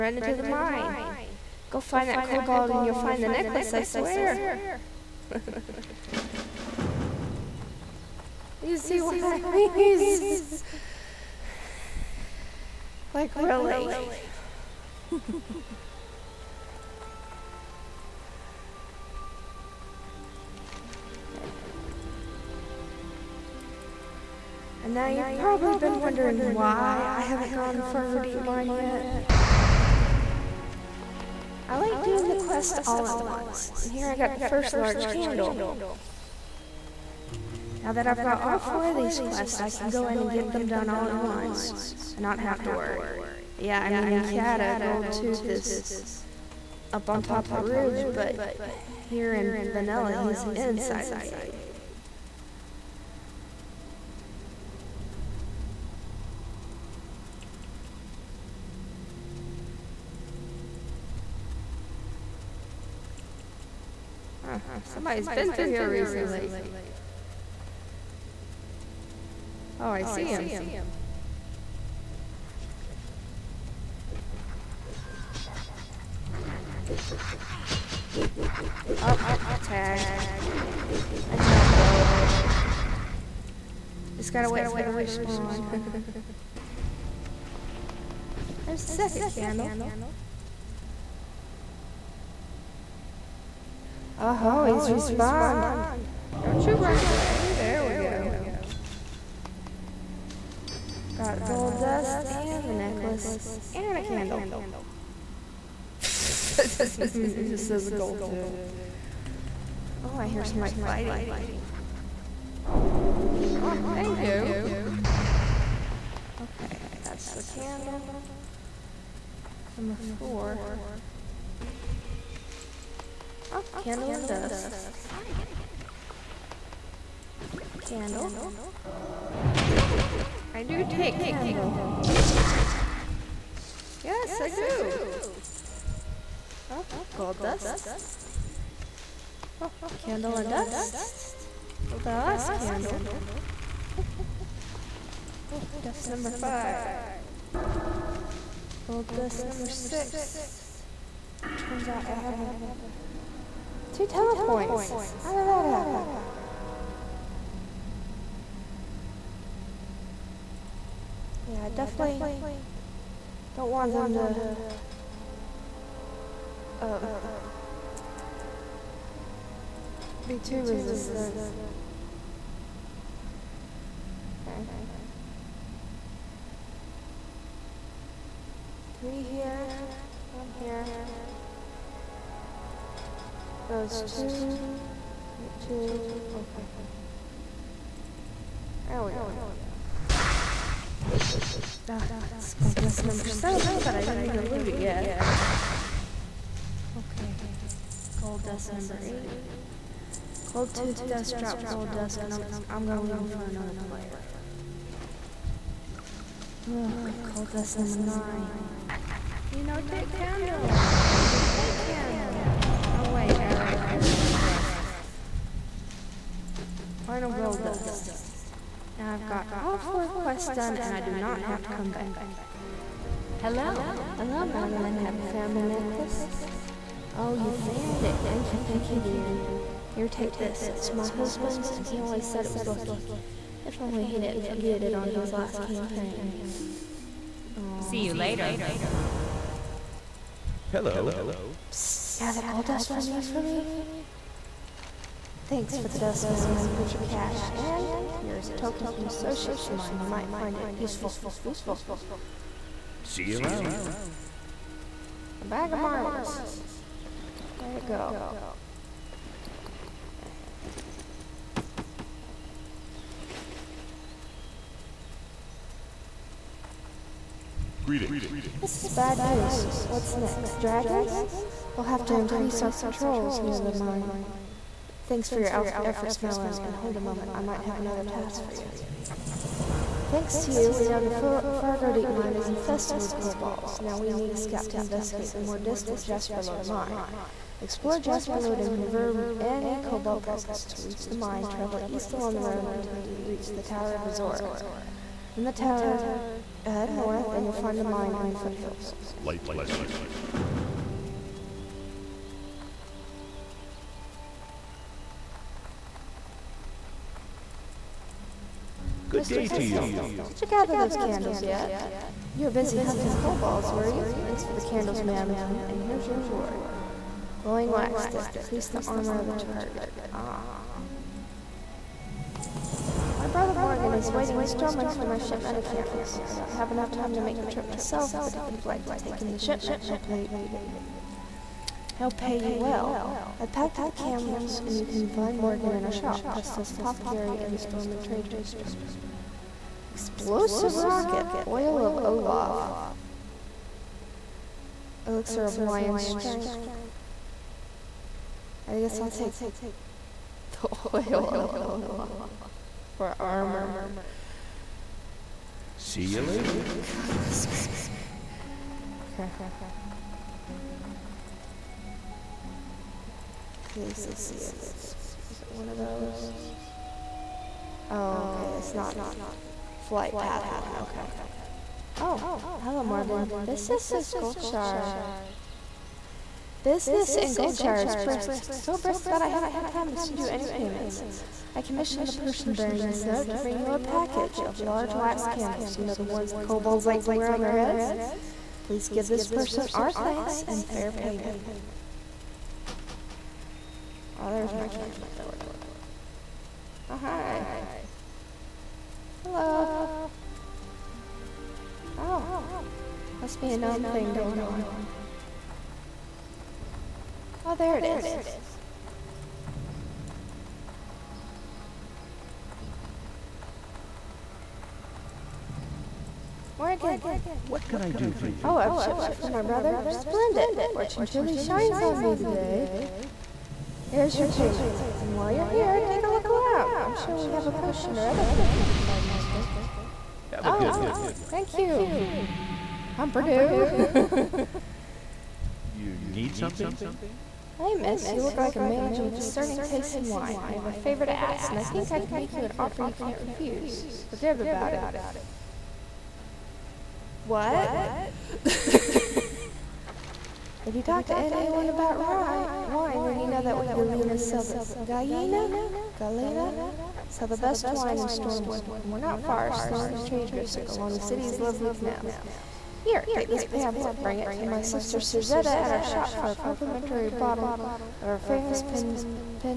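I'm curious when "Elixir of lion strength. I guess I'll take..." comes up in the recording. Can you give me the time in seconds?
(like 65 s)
345 s.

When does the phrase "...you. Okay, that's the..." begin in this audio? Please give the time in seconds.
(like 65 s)
114 s.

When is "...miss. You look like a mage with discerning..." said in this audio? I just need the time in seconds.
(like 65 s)
437 s.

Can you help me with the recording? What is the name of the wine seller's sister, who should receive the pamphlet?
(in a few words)
Suzette.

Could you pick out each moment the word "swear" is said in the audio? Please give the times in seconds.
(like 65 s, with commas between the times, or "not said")
3 s.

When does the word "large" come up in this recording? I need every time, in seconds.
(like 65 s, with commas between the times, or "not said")
34 s, 384 s.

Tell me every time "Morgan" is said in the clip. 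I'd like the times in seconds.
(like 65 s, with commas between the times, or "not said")
323 s, 335 s, 372 s, 416 s.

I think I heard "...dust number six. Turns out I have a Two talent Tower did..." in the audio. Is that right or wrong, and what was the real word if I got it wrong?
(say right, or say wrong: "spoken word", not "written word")
wrong: "How", not "Tower".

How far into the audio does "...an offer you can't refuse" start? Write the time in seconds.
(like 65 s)
442 s.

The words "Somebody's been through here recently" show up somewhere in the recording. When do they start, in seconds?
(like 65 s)
65 s.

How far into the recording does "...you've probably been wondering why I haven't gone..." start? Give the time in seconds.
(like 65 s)
25 s.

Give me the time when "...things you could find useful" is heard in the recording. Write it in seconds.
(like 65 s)
428 s.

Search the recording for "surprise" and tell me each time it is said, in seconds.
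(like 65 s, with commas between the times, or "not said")
not said.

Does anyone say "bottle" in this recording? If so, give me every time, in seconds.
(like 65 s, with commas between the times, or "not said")
467 s.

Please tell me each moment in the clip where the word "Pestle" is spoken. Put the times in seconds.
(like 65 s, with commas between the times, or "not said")
309 s, 336 s.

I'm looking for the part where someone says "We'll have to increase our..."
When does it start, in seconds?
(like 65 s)
271 s.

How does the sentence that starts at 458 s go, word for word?
And we're not far, still in the trade district along the city's lovely canals.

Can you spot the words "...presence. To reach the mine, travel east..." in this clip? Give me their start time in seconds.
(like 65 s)
290 s.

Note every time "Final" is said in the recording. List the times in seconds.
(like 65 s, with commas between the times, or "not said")
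217 s.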